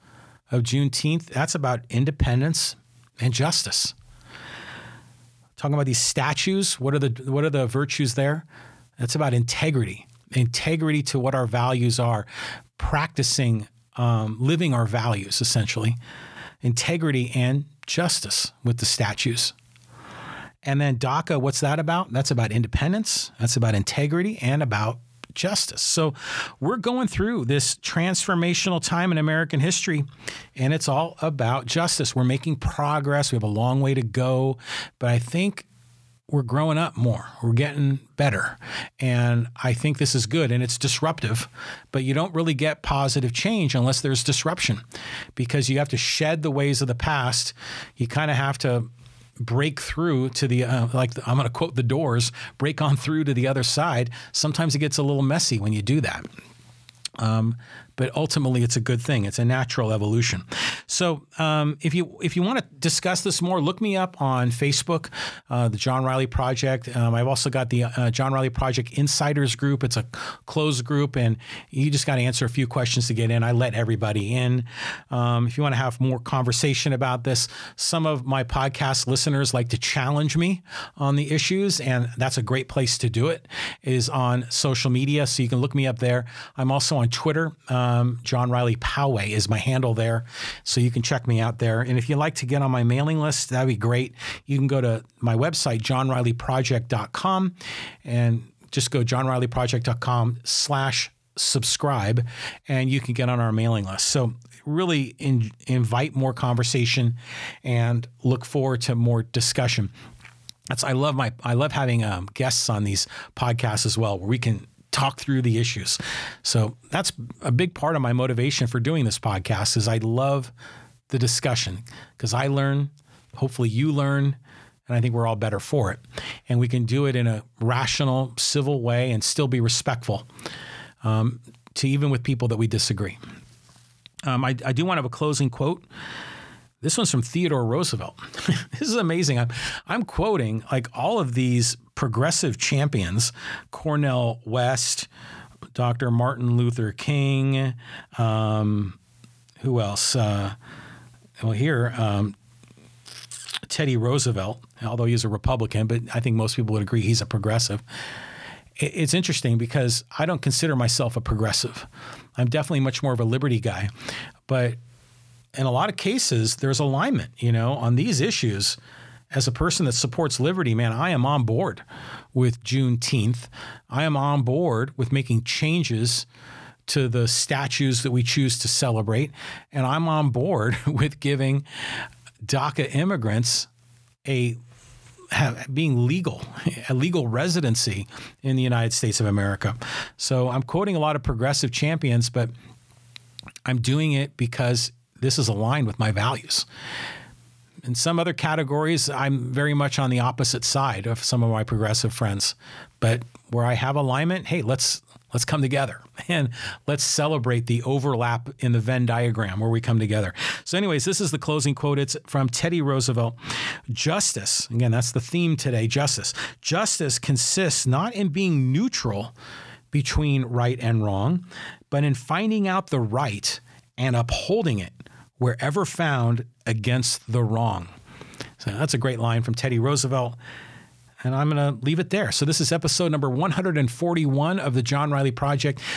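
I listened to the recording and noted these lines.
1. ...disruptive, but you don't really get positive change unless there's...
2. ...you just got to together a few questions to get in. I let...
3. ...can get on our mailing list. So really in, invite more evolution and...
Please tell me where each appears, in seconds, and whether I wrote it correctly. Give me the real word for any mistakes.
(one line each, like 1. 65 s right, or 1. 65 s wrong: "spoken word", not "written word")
1. 40 s right
2. 71 s wrong: "answer", not "together"
3. 102 s wrong: "conversation", not "evolution".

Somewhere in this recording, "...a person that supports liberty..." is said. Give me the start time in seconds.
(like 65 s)
169 s.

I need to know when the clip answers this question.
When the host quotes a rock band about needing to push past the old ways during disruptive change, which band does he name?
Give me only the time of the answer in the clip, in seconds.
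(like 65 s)
51 s.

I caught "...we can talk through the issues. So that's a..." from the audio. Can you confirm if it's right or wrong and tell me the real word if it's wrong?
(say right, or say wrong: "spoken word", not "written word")
right.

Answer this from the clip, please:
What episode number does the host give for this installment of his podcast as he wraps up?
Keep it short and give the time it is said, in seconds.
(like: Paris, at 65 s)
141, at 233 s.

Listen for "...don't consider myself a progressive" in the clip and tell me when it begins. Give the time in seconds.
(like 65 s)
160 s.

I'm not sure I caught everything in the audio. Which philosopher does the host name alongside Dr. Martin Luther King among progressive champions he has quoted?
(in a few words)
Cornel West.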